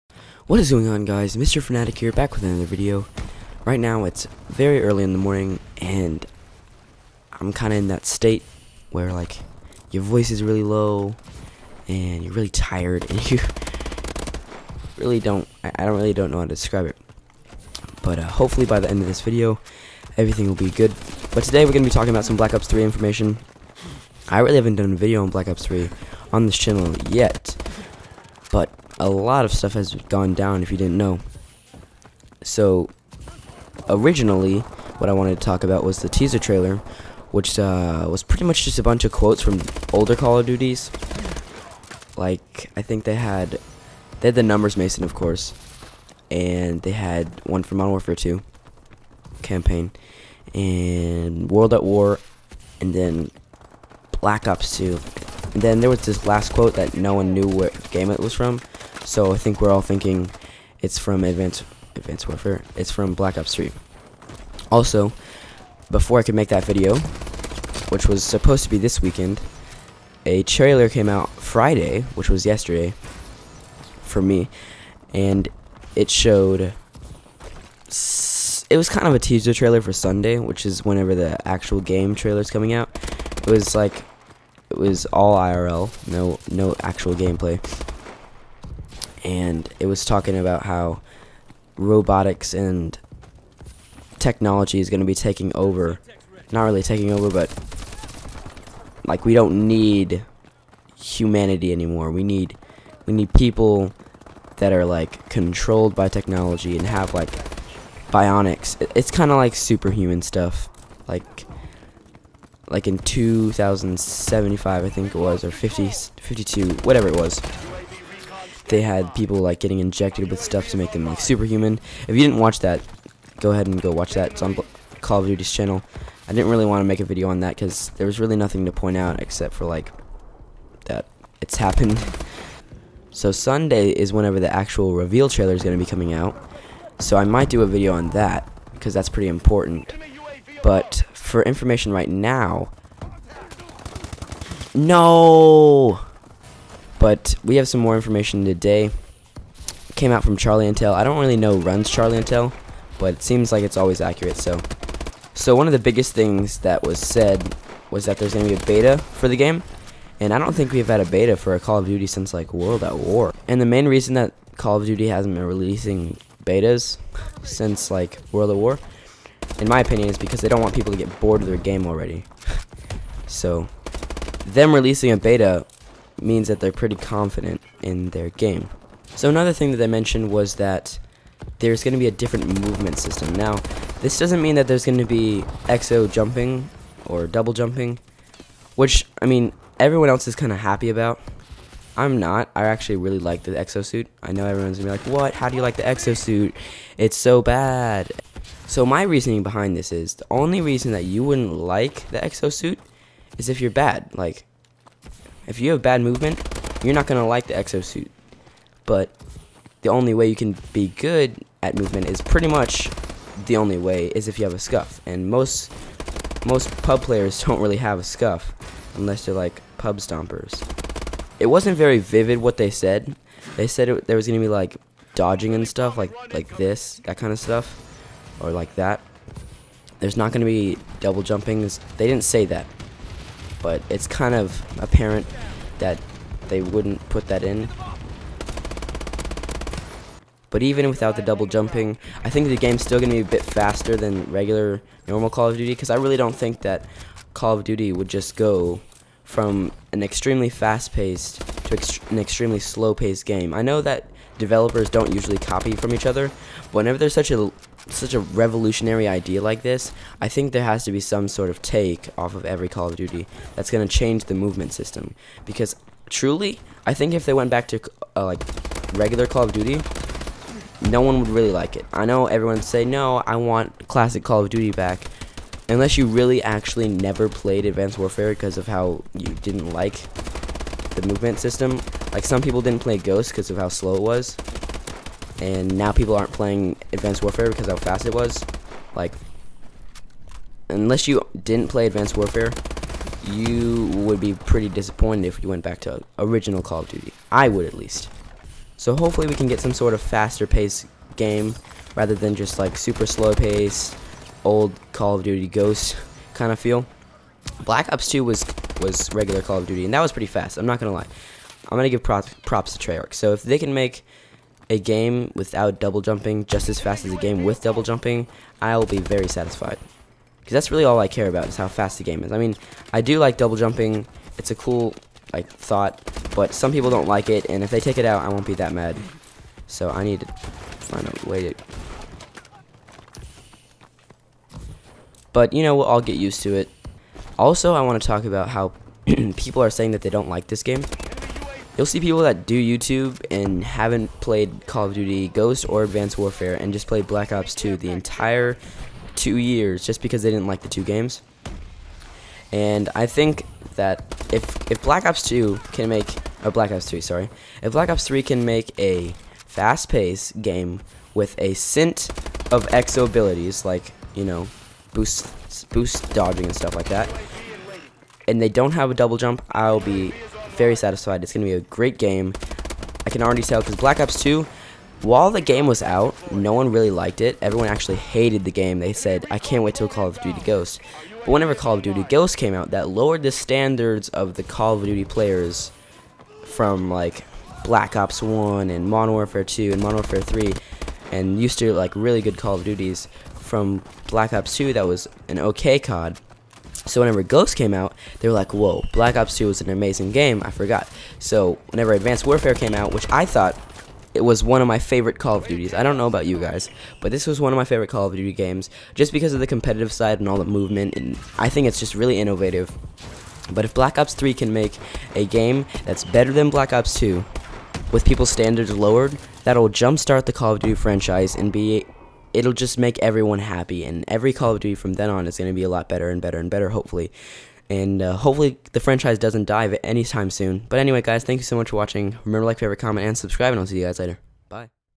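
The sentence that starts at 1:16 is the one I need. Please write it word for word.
It was kind of a teaser trailer for Sunday, which is whenever the actual game trailer is coming out.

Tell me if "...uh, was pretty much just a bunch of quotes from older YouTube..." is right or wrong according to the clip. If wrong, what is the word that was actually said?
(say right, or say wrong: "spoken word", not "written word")
wrong: "Call", not "YouTube".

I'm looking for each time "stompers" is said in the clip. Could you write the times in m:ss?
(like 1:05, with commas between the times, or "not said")
3:39.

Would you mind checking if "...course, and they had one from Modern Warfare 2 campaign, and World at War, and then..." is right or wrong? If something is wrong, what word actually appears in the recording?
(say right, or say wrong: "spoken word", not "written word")
right.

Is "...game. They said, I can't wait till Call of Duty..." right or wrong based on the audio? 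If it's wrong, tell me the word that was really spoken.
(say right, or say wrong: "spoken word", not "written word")
right.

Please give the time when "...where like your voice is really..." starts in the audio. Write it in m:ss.
0:08.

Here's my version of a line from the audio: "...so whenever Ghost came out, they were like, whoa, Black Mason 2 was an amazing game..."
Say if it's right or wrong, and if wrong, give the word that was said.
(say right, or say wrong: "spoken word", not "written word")
wrong: "Ops", not "Mason".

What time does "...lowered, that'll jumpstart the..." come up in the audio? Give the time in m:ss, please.
6:58.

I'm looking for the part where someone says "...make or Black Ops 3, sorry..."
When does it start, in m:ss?
5:55.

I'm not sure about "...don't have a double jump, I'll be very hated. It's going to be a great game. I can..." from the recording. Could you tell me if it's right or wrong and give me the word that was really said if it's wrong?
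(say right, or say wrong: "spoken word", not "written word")
wrong: "satisfied", not "hated".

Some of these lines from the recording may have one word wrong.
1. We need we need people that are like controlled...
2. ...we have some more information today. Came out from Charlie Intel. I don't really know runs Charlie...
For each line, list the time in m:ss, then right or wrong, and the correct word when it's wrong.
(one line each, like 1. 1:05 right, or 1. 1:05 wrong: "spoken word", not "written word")
1. 1:42 right
2. 2:27 right.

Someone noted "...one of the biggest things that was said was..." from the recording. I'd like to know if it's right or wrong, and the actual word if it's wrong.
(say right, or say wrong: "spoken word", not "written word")
right.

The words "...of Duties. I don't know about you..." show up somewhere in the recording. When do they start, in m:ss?
6:45.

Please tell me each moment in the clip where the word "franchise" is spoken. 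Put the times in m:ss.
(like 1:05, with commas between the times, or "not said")
7:00, 7:08.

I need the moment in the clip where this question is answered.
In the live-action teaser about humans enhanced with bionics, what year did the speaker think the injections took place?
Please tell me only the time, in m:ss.
1:52.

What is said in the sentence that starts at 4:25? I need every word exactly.
Because truly, I think if they went back to uh, like regular Call of Duty, no one would really like it.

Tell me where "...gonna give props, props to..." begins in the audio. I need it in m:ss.
5:11.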